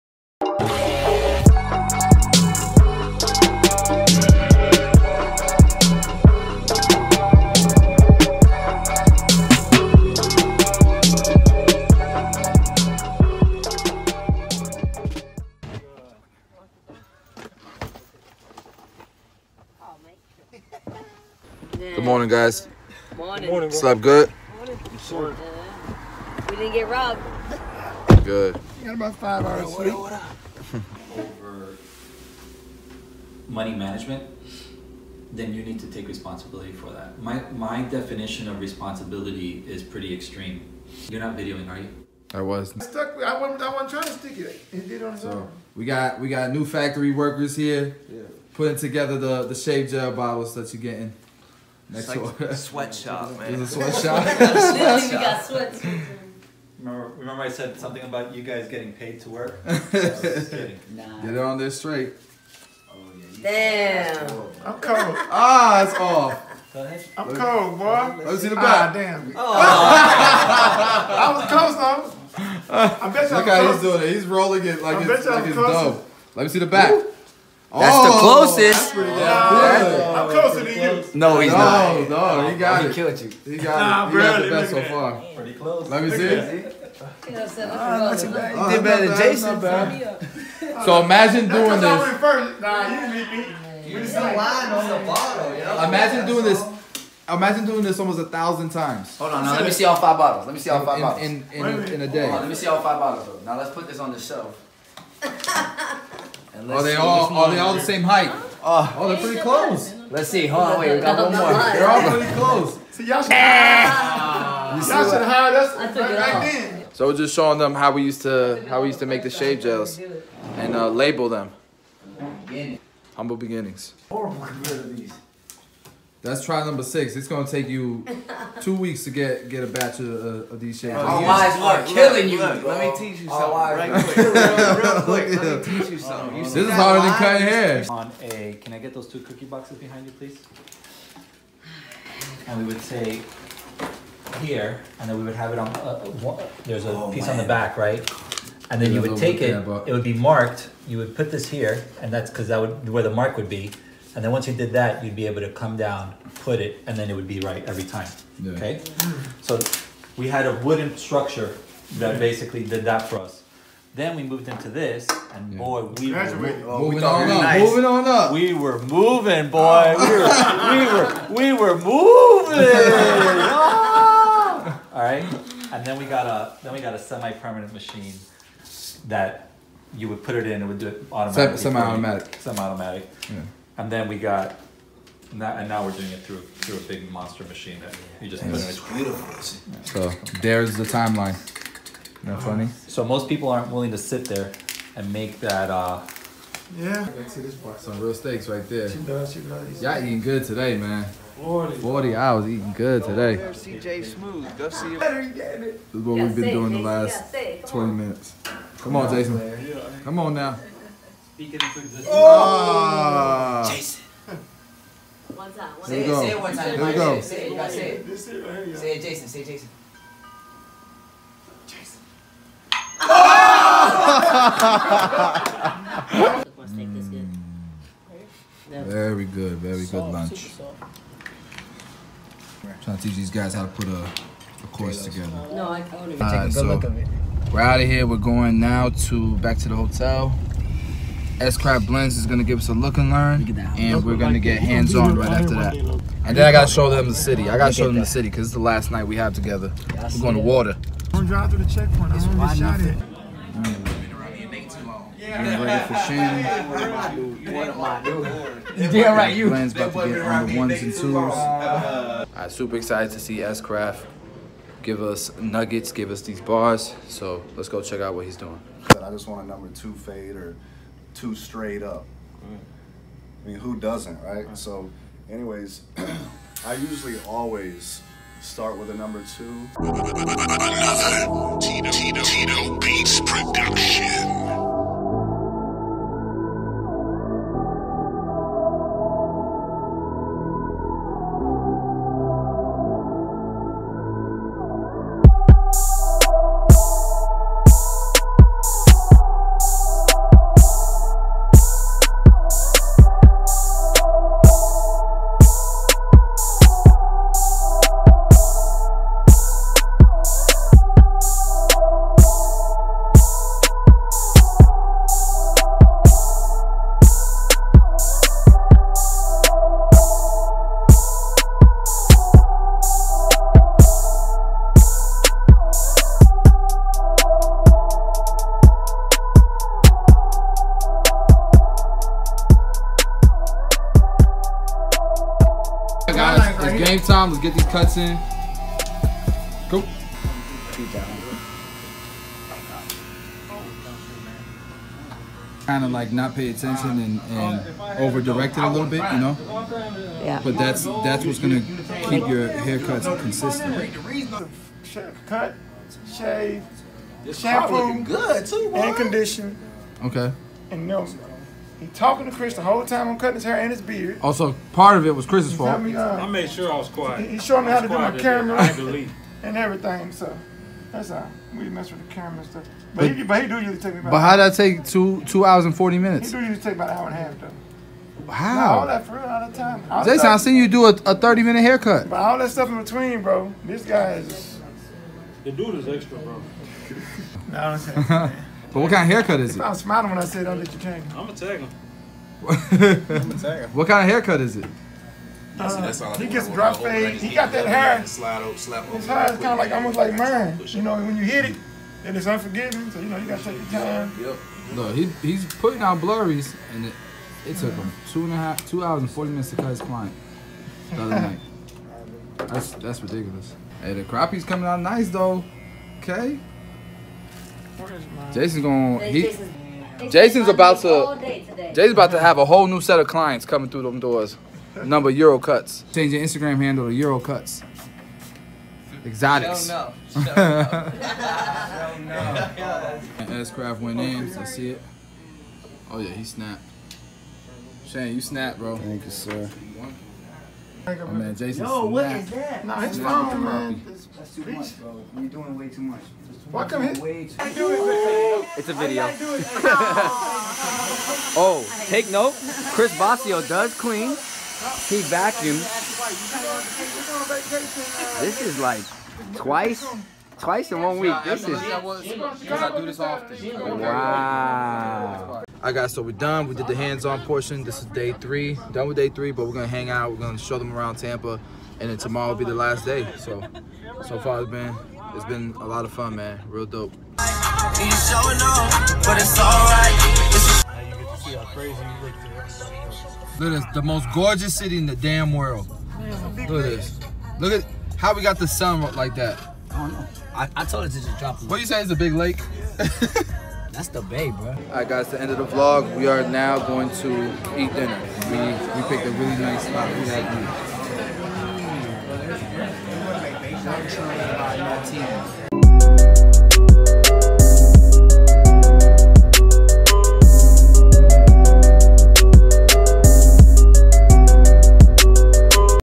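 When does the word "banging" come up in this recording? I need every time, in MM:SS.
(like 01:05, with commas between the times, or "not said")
not said.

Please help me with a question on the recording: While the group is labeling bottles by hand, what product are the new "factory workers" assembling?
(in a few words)
Shave gel bottles.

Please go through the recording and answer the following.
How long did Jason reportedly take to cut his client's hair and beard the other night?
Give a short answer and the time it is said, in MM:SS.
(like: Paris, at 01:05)
2 hours and 40 minutes, at 06:14.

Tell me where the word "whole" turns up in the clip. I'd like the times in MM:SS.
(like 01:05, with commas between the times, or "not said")
06:02, 07:02.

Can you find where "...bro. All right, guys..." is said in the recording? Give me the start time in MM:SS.
08:14.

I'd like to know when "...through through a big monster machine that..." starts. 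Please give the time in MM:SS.
03:06.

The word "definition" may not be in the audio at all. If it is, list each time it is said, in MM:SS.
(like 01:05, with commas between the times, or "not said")
00:37.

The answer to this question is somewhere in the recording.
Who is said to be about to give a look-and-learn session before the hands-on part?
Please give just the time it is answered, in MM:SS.
04:01.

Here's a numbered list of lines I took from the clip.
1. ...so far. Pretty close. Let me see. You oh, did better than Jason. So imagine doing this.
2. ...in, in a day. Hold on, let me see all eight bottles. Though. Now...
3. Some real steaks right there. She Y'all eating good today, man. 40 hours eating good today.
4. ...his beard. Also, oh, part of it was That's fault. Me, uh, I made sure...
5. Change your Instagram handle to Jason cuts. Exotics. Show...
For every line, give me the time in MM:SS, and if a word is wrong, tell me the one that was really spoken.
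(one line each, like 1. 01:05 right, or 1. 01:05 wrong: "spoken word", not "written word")
1. 01:24 right
2. 01:41 wrong: "five", not "eight"
3. 03:17 right
4. 06:03 wrong: "Chris", not "That"
5. 07:05 wrong: "Euro", not "Jason".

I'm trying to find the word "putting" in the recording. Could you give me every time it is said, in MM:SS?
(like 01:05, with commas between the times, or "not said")
00:48, 06:45.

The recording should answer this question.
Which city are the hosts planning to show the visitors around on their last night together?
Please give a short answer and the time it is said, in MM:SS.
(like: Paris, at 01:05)
Tampa, at 07:50.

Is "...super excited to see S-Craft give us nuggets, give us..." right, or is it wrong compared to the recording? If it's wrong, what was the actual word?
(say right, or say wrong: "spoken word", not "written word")
right.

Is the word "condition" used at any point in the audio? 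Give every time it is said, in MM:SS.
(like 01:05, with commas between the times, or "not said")
05:58.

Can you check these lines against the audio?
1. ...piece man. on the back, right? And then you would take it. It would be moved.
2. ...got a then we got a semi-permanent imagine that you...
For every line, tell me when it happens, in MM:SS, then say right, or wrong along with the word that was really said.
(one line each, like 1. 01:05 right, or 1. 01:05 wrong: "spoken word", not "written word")
1. 02:27 wrong: "marked", not "moved"
2. 02:56 wrong: "machine", not "imagine".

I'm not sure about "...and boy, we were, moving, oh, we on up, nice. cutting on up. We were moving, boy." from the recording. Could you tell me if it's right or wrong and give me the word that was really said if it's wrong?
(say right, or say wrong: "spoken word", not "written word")
wrong: "moving", not "cutting".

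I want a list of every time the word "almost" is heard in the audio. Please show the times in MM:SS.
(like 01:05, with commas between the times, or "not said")
01:37, 06:39.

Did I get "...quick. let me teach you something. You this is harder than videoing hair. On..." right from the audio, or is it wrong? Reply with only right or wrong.
wrong.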